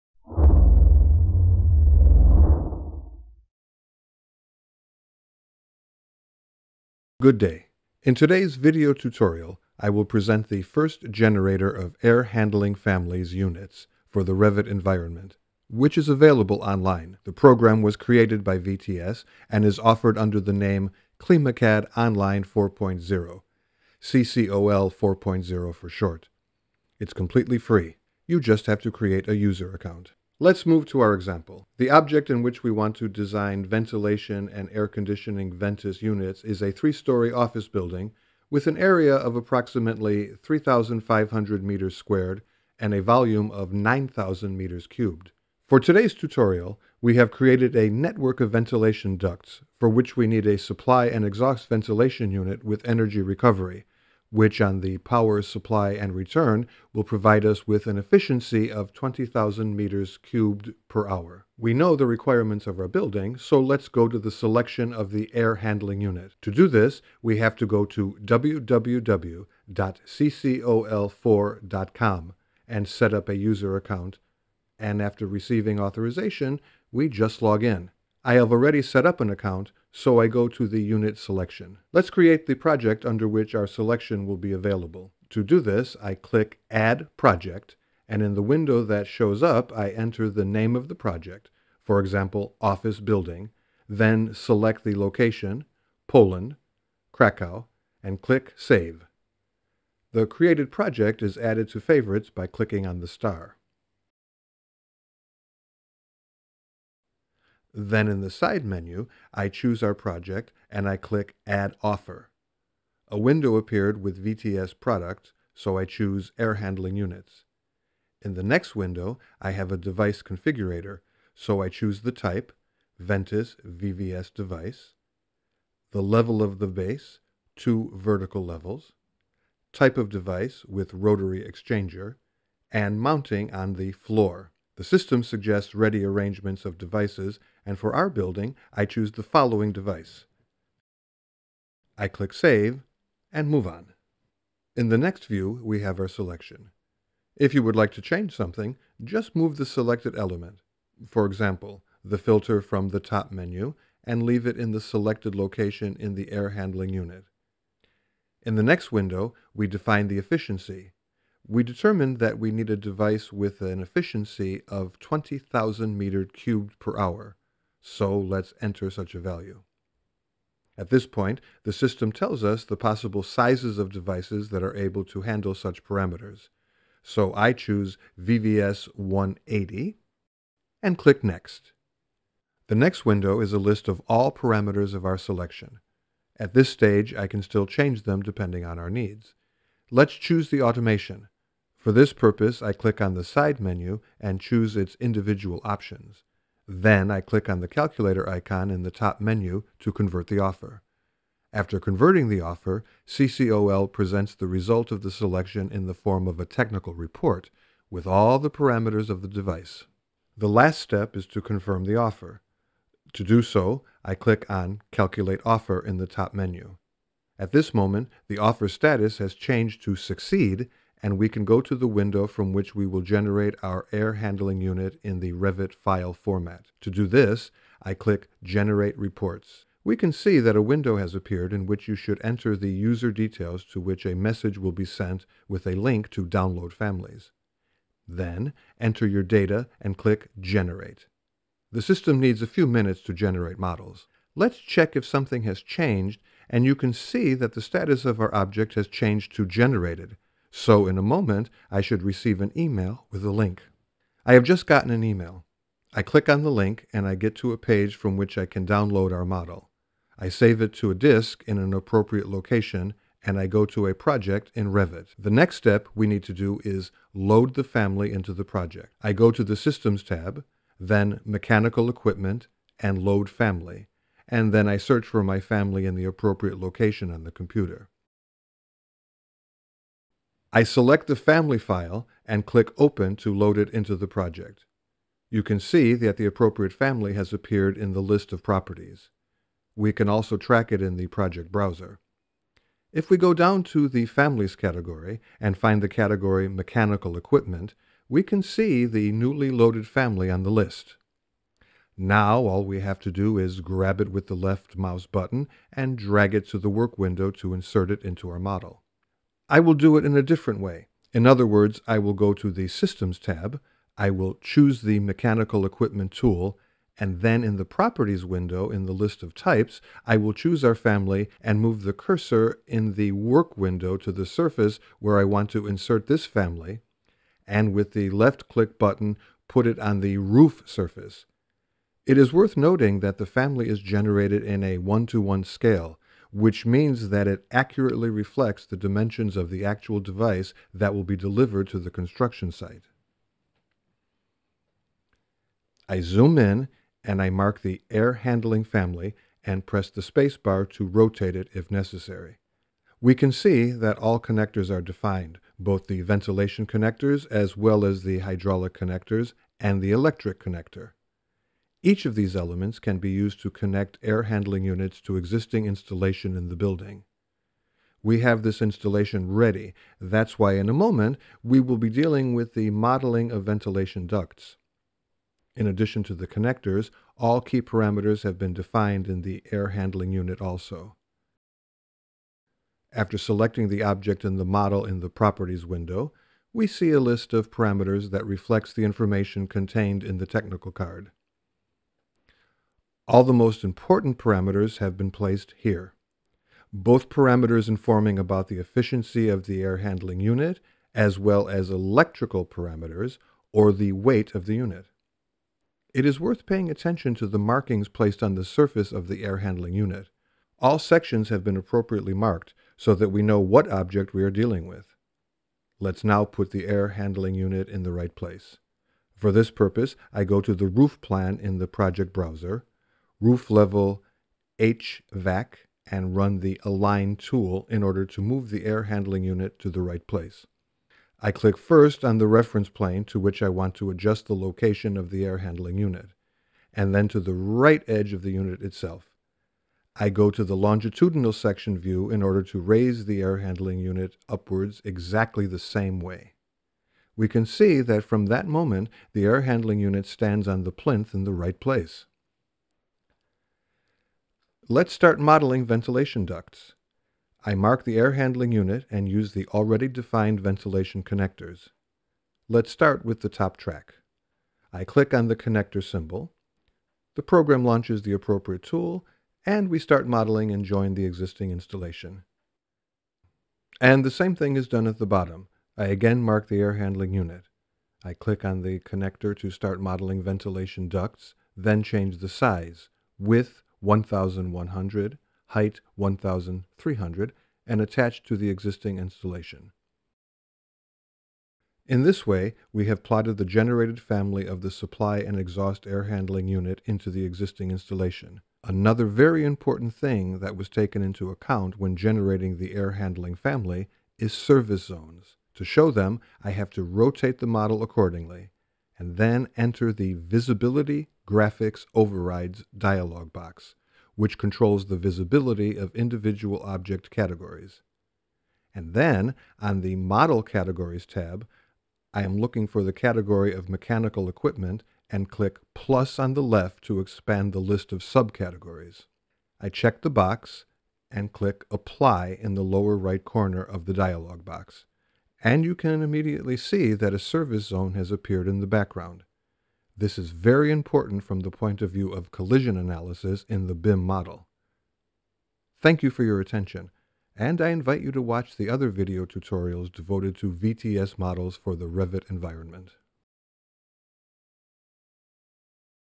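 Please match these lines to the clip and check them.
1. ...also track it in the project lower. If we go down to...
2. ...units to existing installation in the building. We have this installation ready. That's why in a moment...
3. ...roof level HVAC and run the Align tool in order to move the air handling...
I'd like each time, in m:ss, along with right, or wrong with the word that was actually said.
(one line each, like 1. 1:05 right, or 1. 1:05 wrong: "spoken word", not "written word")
1. 4:50 wrong: "browser", not "lower"
2. 6:04 right
3. 7:03 right.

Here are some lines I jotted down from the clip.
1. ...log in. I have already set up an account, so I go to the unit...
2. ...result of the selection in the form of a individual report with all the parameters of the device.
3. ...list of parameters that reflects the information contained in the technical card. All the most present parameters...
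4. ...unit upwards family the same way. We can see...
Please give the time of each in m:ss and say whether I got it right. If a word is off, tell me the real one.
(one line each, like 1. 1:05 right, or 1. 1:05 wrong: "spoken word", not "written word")
1. 1:17 right
2. 3:24 wrong: "technical", not "individual"
3. 6:26 wrong: "important", not "present"
4. 7:23 wrong: "exactly", not "family".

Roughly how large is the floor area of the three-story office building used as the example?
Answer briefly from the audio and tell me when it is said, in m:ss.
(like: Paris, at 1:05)
3,500 square meters, at 0:40.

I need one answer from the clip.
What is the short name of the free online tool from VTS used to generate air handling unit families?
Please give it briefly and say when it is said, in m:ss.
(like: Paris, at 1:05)
CCOL 4.0, at 0:24.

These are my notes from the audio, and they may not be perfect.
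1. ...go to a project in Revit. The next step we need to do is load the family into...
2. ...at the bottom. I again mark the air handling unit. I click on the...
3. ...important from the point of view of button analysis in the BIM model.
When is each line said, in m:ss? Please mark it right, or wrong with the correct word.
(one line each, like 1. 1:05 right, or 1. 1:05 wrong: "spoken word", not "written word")
1. 4:23 right
2. 7:54 right
3. 9:00 wrong: "collision", not "button".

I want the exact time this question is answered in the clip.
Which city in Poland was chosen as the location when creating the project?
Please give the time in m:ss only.
1:37.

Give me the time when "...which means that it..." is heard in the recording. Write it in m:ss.
5:36.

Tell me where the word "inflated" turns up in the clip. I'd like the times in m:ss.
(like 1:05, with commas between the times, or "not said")
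not said.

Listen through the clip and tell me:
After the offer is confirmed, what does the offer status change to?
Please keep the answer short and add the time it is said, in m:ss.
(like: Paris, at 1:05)
Succeed, at 3:39.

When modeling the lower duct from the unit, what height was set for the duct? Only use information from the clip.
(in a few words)
1,300.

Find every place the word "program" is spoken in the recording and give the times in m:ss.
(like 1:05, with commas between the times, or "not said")
0:17, 7:47.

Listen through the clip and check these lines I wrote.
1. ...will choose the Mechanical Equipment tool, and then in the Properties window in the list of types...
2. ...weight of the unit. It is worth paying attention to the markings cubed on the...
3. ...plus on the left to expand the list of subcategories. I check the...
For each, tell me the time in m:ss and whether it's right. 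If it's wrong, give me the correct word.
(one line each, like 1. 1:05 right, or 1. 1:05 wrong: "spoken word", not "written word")
1. 5:14 right
2. 6:43 wrong: "placed", not "cubed"
3. 8:45 right.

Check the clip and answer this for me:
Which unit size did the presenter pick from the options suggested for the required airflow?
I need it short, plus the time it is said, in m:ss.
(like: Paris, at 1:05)
VVS 180, at 2:58.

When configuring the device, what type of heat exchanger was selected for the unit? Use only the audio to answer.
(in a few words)
rotary exchanger.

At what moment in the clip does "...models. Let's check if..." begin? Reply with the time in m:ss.
4:03.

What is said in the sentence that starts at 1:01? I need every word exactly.
We know the requirements of our building, so let's go to the selection of the air handling unit.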